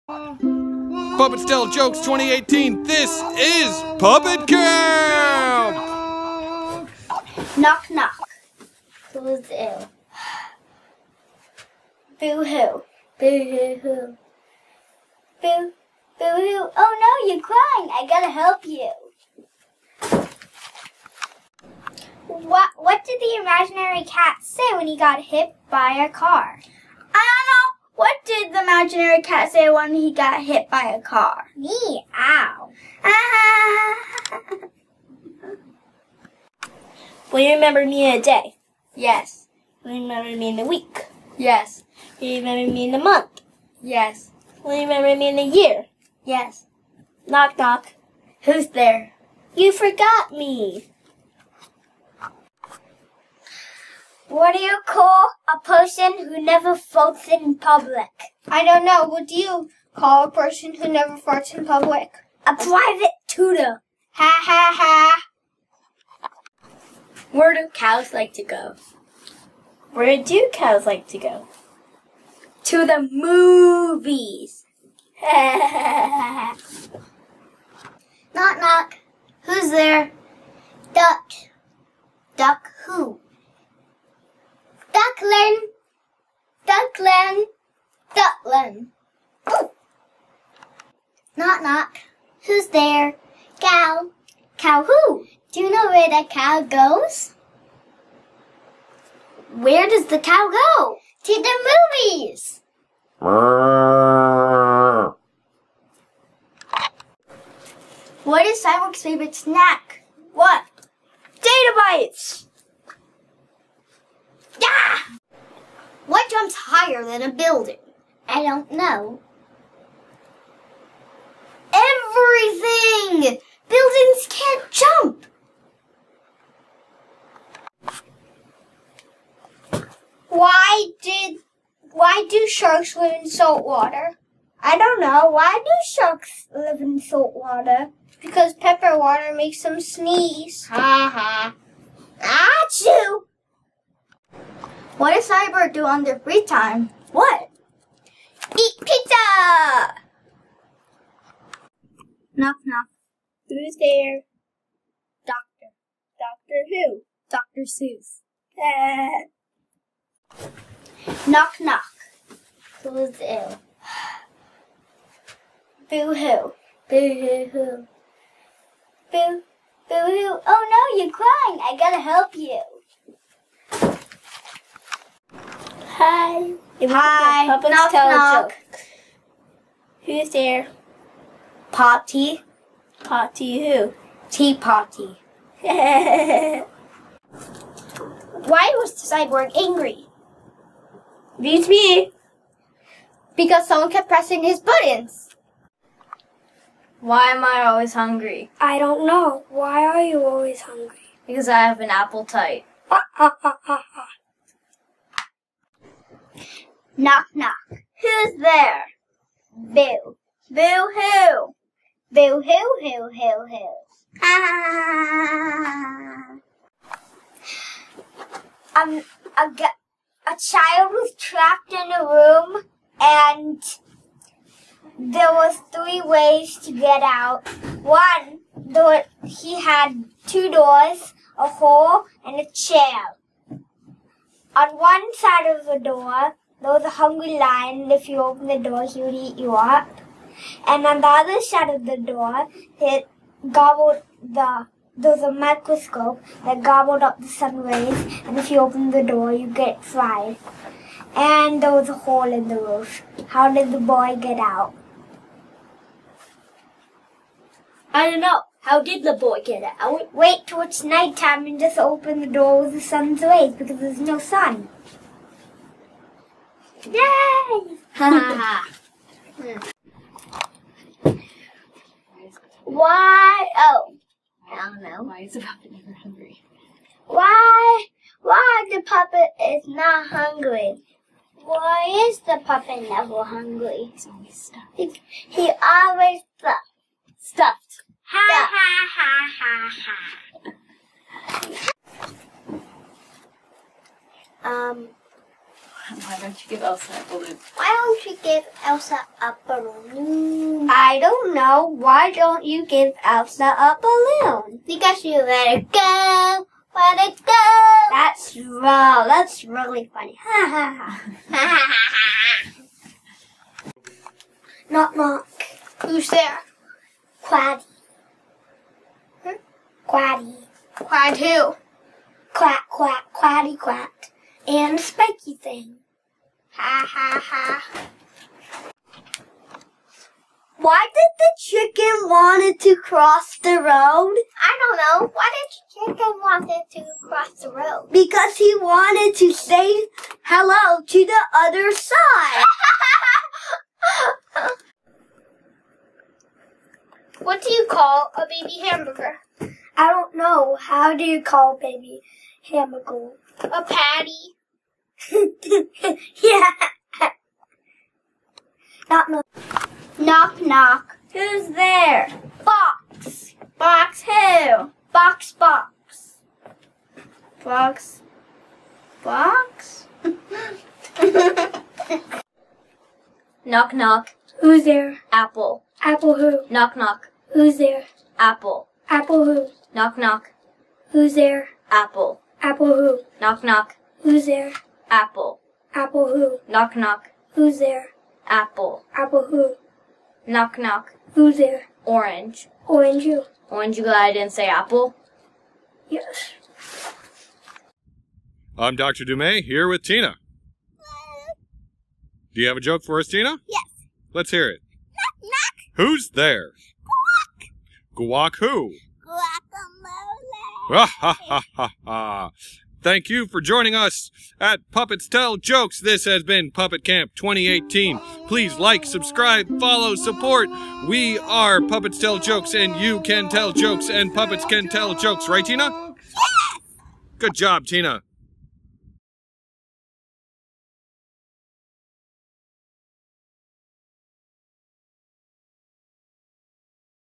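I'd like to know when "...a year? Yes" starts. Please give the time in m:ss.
0:45.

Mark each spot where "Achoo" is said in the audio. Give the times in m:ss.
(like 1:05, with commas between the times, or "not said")
2:22.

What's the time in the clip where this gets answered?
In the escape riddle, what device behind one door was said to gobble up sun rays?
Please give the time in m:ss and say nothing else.
4:05.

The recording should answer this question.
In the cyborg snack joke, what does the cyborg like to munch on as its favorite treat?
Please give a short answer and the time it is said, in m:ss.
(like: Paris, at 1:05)
Data bites, at 1:51.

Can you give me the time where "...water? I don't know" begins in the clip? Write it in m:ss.
2:13.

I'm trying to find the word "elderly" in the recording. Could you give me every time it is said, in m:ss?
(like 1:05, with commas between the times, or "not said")
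not said.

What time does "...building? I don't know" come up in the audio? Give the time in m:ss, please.
1:57.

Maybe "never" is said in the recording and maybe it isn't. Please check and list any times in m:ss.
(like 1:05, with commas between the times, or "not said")
0:56, 1:00, 4:35, 4:42.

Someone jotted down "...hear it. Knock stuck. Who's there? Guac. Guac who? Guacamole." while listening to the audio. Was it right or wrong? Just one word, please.
wrong.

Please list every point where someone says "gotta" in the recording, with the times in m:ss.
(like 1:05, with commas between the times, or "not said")
0:18, 2:51.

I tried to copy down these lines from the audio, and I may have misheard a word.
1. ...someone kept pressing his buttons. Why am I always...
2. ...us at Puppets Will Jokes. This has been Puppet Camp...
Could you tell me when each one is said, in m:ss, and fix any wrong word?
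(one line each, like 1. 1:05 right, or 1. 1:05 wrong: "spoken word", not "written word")
1. 3:13 right
2. 6:53 wrong: "Tell", not "Will".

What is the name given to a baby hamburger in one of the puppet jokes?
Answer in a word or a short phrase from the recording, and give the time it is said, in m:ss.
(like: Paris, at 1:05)
A patty, at 5:53.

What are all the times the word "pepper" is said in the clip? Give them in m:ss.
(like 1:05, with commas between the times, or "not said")
2:18.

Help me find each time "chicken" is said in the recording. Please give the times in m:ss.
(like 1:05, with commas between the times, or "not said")
5:31, 5:35.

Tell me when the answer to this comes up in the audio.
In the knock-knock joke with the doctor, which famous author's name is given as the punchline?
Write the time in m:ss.
2:37.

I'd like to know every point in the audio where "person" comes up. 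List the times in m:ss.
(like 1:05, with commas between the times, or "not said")
0:55, 1:00.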